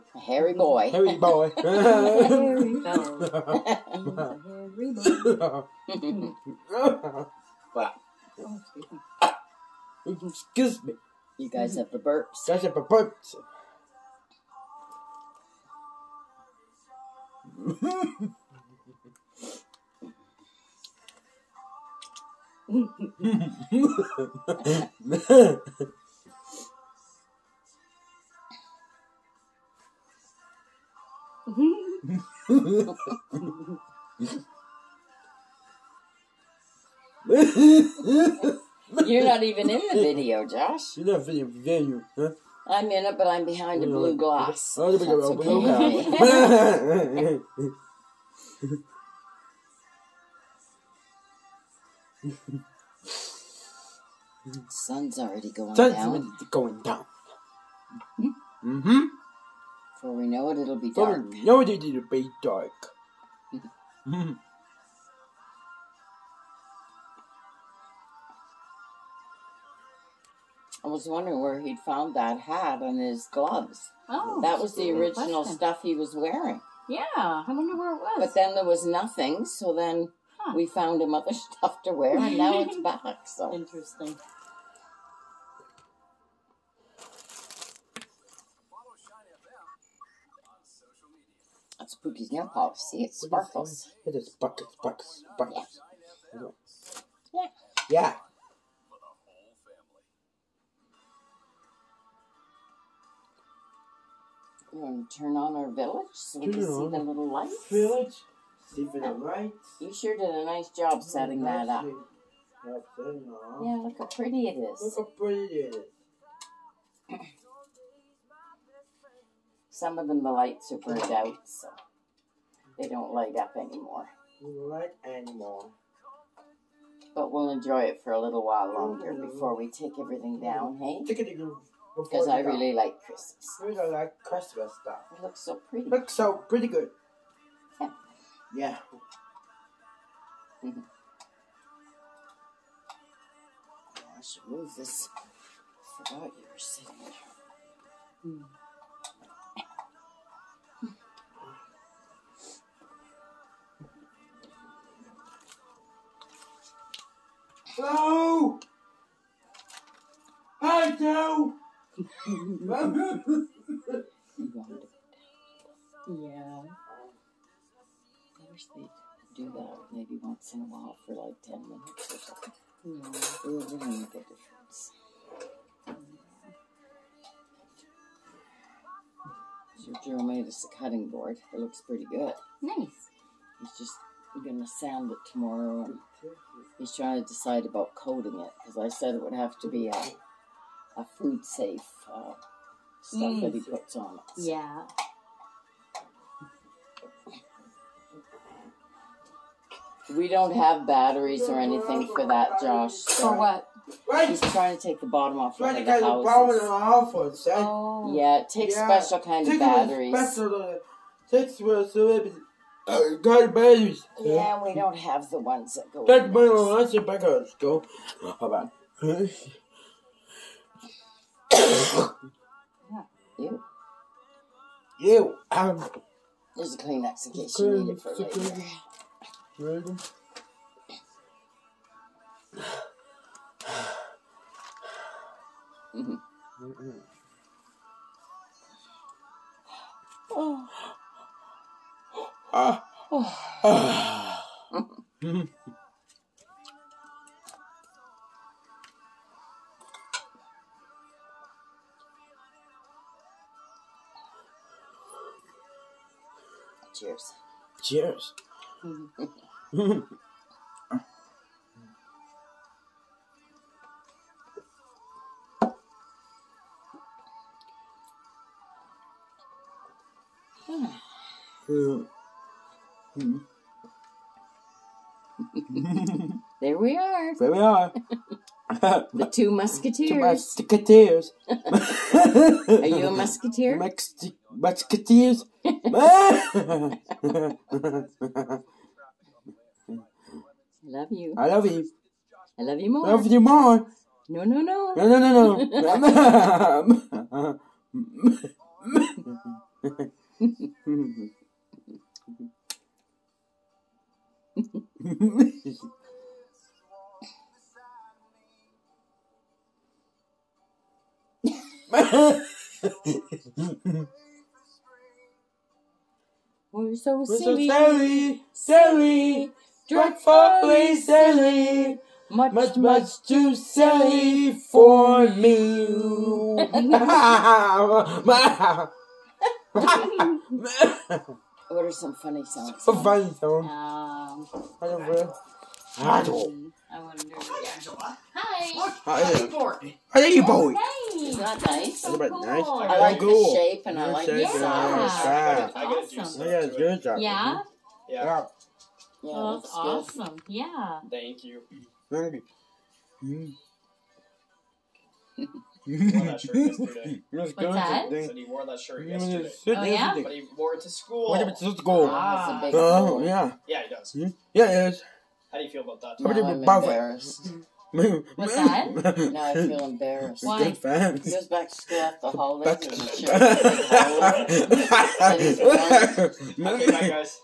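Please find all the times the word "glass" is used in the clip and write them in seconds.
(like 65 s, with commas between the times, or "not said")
44 s.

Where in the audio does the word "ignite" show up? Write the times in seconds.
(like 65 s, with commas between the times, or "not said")
not said.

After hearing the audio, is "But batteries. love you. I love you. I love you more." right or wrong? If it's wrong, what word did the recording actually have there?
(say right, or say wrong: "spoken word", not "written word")
wrong: "continues", not "batteries".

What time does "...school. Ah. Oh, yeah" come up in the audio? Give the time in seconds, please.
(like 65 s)
361 s.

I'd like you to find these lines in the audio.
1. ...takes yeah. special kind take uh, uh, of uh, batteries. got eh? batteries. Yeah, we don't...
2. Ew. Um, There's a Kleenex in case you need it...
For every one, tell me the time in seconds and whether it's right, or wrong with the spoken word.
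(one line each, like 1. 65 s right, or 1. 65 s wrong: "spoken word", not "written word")
1. 208 s right
2. 224 s right.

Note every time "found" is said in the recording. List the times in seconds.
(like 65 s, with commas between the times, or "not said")
71 s, 80 s.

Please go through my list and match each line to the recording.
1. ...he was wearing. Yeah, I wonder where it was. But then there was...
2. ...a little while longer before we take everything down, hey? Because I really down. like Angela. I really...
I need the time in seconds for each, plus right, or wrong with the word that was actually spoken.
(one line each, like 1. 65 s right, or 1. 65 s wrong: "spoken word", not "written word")
1. 75 s right
2. 128 s wrong: "Christmas", not "Angela".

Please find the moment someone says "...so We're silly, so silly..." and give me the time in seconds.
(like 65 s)
316 s.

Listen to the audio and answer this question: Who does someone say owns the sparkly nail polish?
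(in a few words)
Pookie's.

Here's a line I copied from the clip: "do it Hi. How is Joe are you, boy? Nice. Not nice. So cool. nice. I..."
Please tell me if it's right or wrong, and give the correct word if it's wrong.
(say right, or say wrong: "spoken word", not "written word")
wrong: "How", not "Joe".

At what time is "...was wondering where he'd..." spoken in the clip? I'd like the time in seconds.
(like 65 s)
70 s.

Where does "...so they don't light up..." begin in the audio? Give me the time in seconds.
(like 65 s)
121 s.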